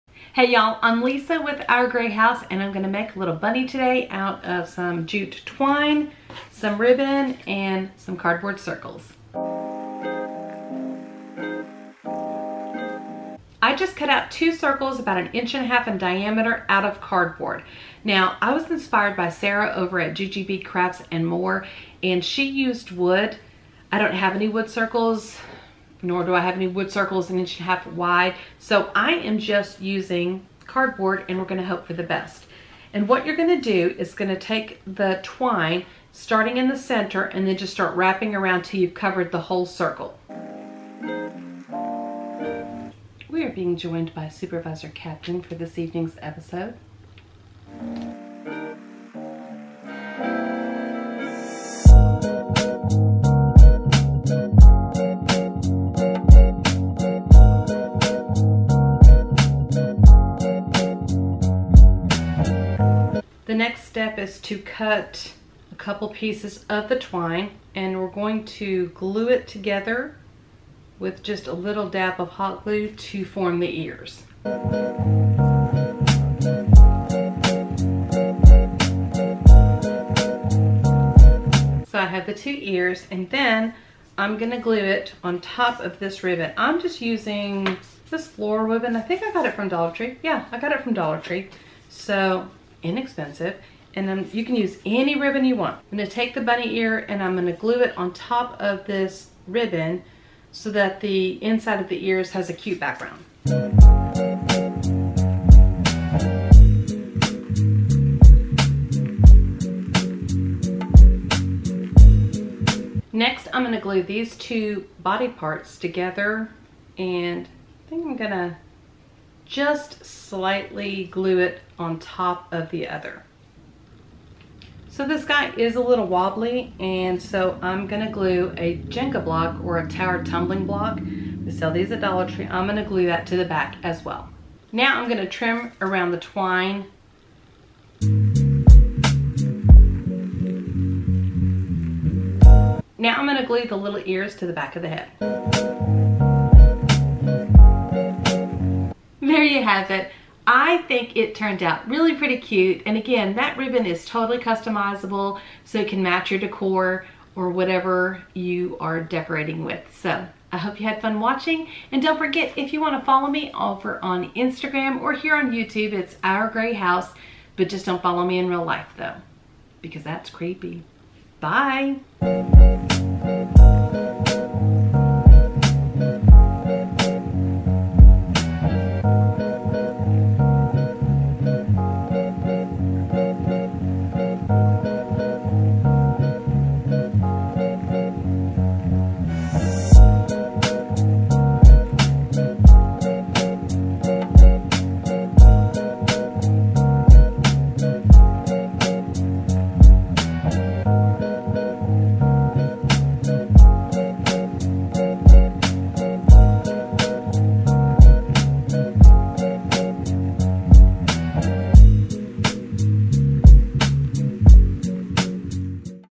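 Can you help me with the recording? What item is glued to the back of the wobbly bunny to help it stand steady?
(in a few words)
Jenga block.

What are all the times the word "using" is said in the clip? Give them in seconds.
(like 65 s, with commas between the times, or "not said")
29 s, 86 s.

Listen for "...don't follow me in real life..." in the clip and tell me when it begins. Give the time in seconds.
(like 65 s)
167 s.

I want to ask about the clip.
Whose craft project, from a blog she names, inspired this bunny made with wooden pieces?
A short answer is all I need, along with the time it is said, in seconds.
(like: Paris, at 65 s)
Sarah, at 19 s.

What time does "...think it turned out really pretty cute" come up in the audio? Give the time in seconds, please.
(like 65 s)
150 s.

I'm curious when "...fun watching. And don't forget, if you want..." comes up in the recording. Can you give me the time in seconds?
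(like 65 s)
161 s.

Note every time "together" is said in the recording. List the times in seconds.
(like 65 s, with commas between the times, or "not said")
69 s, 115 s.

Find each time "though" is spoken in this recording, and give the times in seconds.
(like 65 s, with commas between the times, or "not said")
168 s.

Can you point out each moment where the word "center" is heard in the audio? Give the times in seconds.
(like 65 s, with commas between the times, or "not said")
36 s.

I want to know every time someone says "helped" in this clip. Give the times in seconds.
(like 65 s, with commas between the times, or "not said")
not said.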